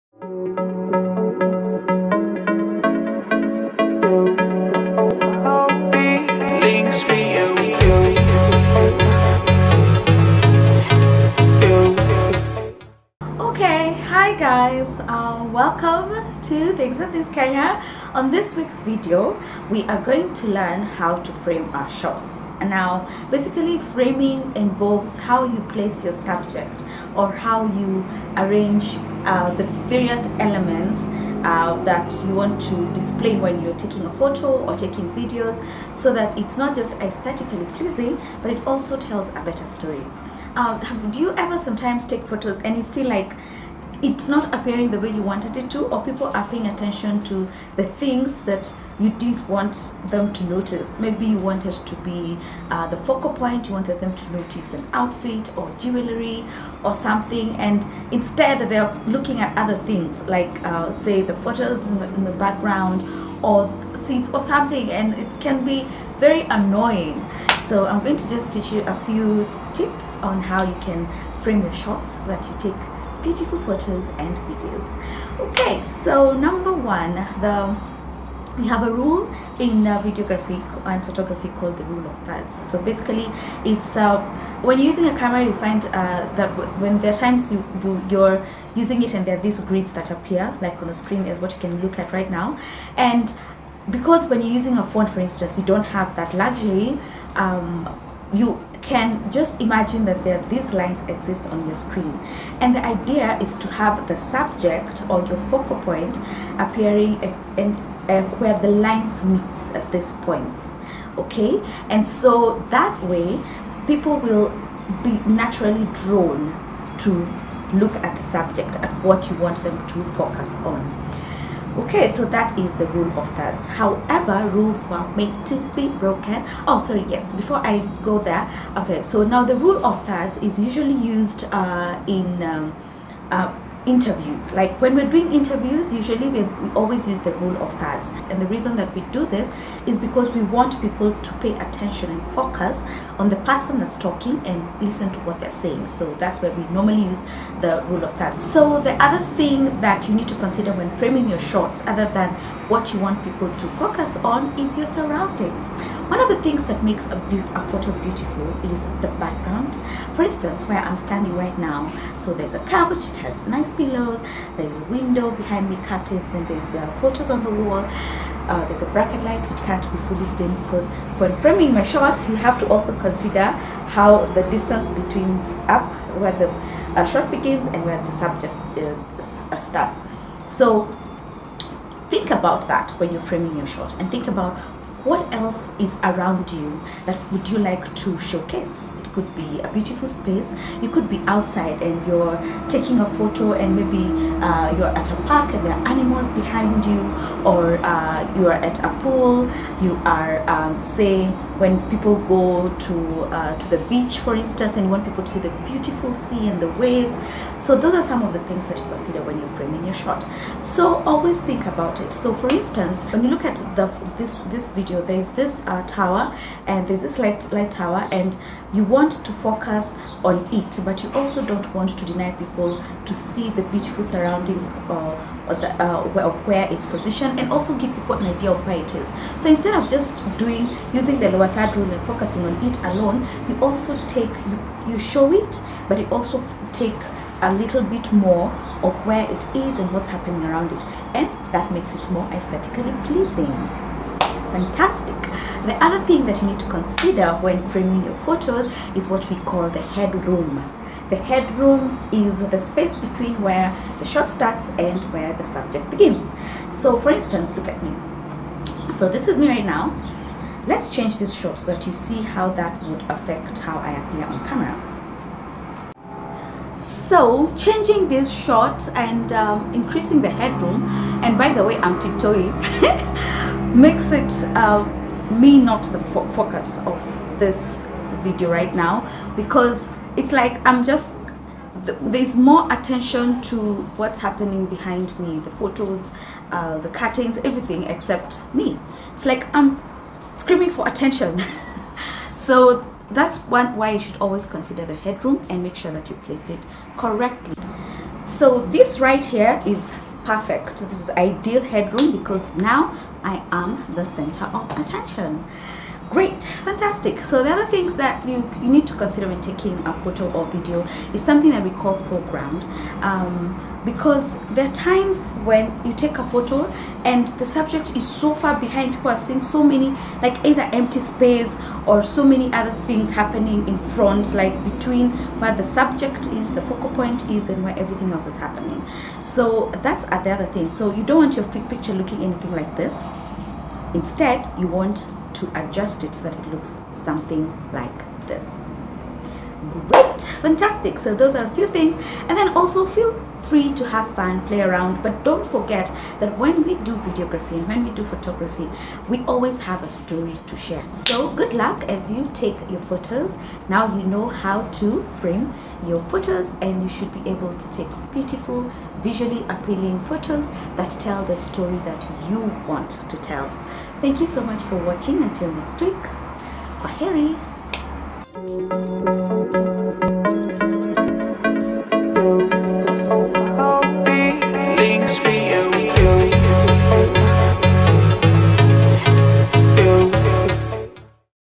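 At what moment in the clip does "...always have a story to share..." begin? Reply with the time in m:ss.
5:49.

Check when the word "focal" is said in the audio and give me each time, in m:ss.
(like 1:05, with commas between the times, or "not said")
0:52, 1:45, 5:26.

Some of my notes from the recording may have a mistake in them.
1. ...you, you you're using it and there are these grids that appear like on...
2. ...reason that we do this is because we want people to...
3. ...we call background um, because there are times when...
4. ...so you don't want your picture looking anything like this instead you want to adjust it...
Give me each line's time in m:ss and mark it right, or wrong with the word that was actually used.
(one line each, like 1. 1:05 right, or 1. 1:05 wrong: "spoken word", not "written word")
1. 1:27 right
2. 2:18 right
3. 5:11 wrong: "foreground", not "background"
4. 5:30 right.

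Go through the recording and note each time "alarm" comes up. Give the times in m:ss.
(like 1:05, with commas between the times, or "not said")
not said.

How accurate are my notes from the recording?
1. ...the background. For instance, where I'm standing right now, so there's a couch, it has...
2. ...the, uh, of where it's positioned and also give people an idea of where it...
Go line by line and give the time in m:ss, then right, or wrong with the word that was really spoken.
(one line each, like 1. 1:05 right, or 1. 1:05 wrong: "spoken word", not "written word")
1. 2:38 right
2. 3:45 right.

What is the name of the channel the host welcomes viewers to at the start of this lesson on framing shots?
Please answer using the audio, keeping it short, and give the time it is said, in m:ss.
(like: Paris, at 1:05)
Things and Things Kenya, at 0:16.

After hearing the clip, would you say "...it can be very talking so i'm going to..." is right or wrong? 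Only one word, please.
wrong.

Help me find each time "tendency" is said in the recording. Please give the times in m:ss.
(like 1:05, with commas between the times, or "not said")
not said.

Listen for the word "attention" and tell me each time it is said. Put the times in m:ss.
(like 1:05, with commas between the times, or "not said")
0:46, 2:21, 4:42, 4:50, 5:04.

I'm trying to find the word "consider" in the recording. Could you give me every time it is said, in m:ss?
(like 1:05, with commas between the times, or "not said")
2:30, 2:52, 3:28, 4:06, 4:54, 5:08.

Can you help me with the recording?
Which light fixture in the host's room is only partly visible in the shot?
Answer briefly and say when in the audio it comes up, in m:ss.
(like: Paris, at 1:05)
Bracket light, at 2:48.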